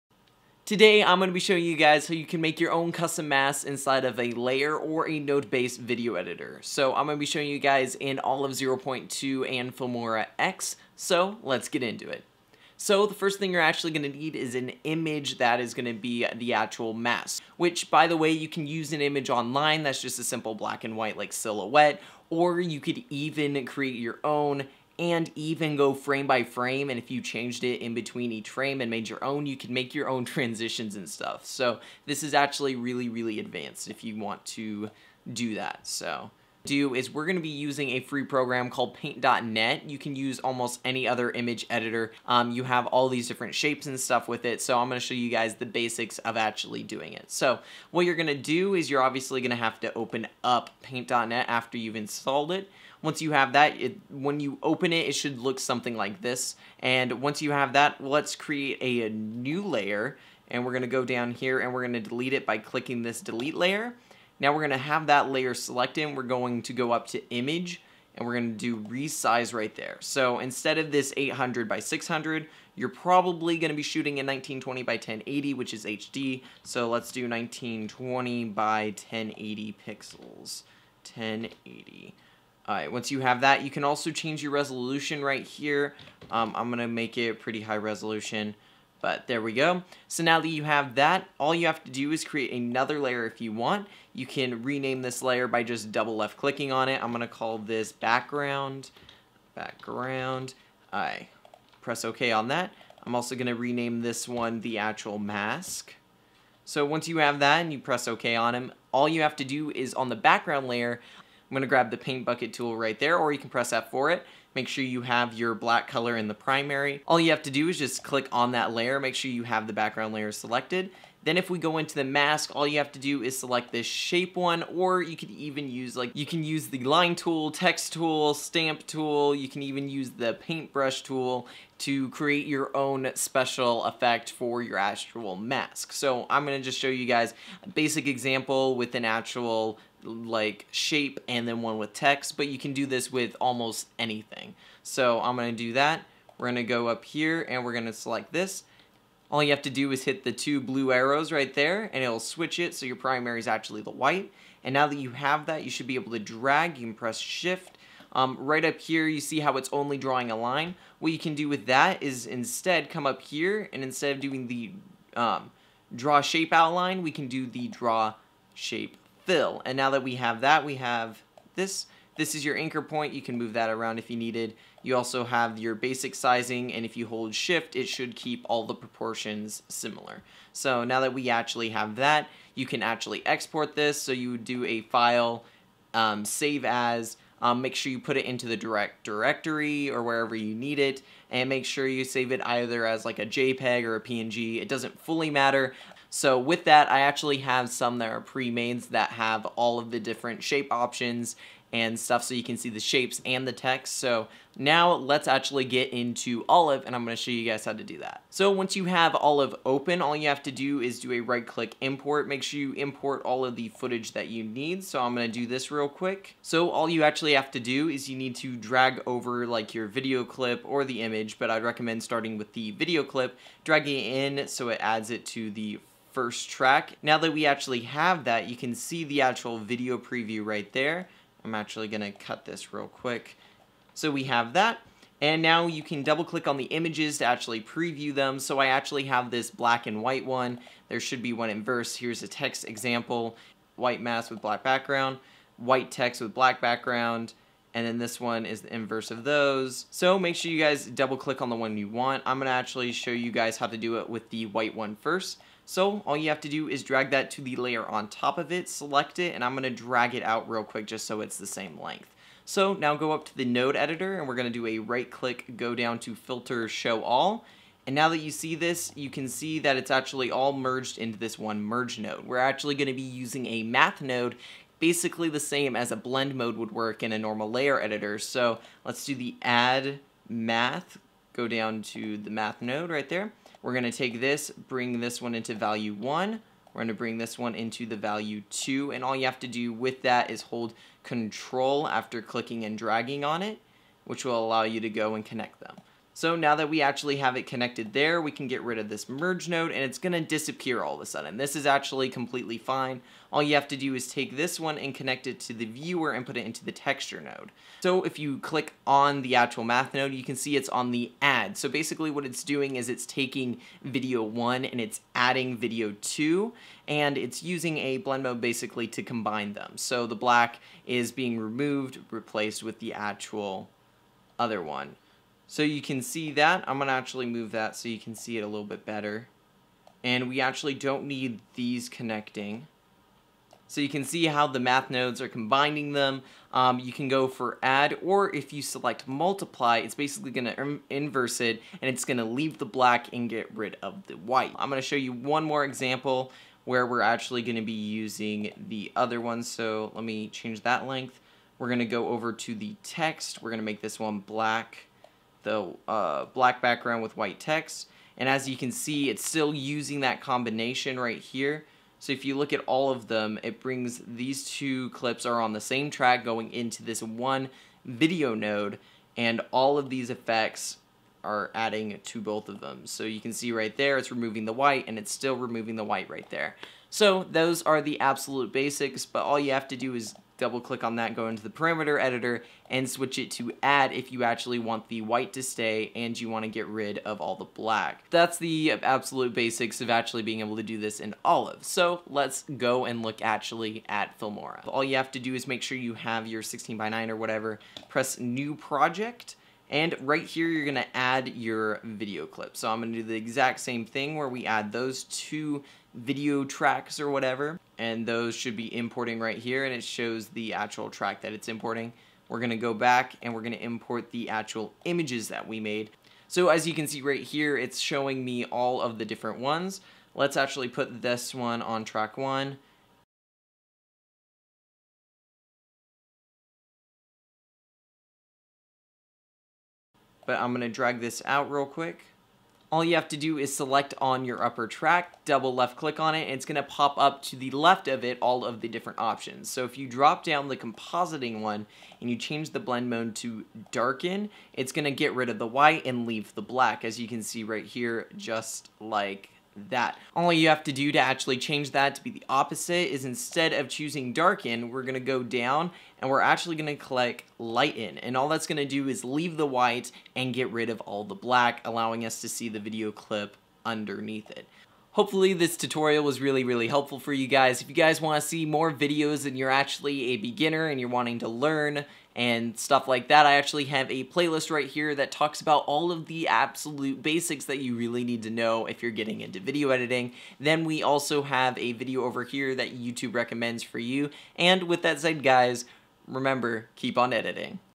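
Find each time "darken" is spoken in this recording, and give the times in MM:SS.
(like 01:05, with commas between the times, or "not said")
07:23, 07:34.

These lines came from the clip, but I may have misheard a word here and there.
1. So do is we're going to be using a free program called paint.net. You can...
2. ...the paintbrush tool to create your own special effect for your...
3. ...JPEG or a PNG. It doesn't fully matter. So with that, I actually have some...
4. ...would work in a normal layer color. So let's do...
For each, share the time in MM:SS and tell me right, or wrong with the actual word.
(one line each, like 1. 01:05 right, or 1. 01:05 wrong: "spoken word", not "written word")
1. 00:35 right
2. 02:10 right
3. 03:13 right
4. 04:36 wrong: "editor", not "color".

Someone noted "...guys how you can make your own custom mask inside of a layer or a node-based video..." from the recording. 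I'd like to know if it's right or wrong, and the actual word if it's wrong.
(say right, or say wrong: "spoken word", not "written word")
right.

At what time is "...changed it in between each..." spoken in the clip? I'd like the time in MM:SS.
00:27.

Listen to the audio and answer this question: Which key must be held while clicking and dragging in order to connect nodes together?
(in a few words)
Control.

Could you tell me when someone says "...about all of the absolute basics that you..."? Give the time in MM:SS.
07:55.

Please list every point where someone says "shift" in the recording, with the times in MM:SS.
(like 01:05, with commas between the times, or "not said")
02:37, 02:57.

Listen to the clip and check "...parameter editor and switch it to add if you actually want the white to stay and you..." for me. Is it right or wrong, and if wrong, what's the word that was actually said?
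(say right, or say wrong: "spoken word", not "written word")
right.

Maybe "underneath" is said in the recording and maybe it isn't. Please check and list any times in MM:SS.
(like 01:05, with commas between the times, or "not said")
07:43.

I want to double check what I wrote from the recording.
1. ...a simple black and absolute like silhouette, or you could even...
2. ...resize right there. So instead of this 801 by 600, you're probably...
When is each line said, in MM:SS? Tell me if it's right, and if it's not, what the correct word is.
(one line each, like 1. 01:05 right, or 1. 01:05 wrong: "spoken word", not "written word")
1. 00:20 wrong: "white", not "absolute"
2. 01:08 wrong: "800", not "801".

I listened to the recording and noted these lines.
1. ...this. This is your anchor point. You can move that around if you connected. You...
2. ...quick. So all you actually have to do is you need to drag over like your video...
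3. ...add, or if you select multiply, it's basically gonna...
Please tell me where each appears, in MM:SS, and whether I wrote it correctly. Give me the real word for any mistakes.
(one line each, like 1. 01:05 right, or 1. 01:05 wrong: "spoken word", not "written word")
1. 02:51 wrong: "needed", not "connected"
2. 03:35 right
3. 05:37 right.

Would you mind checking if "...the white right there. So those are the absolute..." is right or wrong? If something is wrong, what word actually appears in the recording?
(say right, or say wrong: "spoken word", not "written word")
right.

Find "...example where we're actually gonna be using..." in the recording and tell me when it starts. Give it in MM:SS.
05:45.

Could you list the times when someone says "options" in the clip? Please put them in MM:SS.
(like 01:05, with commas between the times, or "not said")
03:20, 07:18.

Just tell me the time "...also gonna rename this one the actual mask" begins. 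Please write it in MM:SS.
01:43.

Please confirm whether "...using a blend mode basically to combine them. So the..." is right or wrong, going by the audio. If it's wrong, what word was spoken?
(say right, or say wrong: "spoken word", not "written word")
right.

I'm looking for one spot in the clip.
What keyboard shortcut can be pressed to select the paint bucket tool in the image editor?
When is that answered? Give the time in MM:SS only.
01:53.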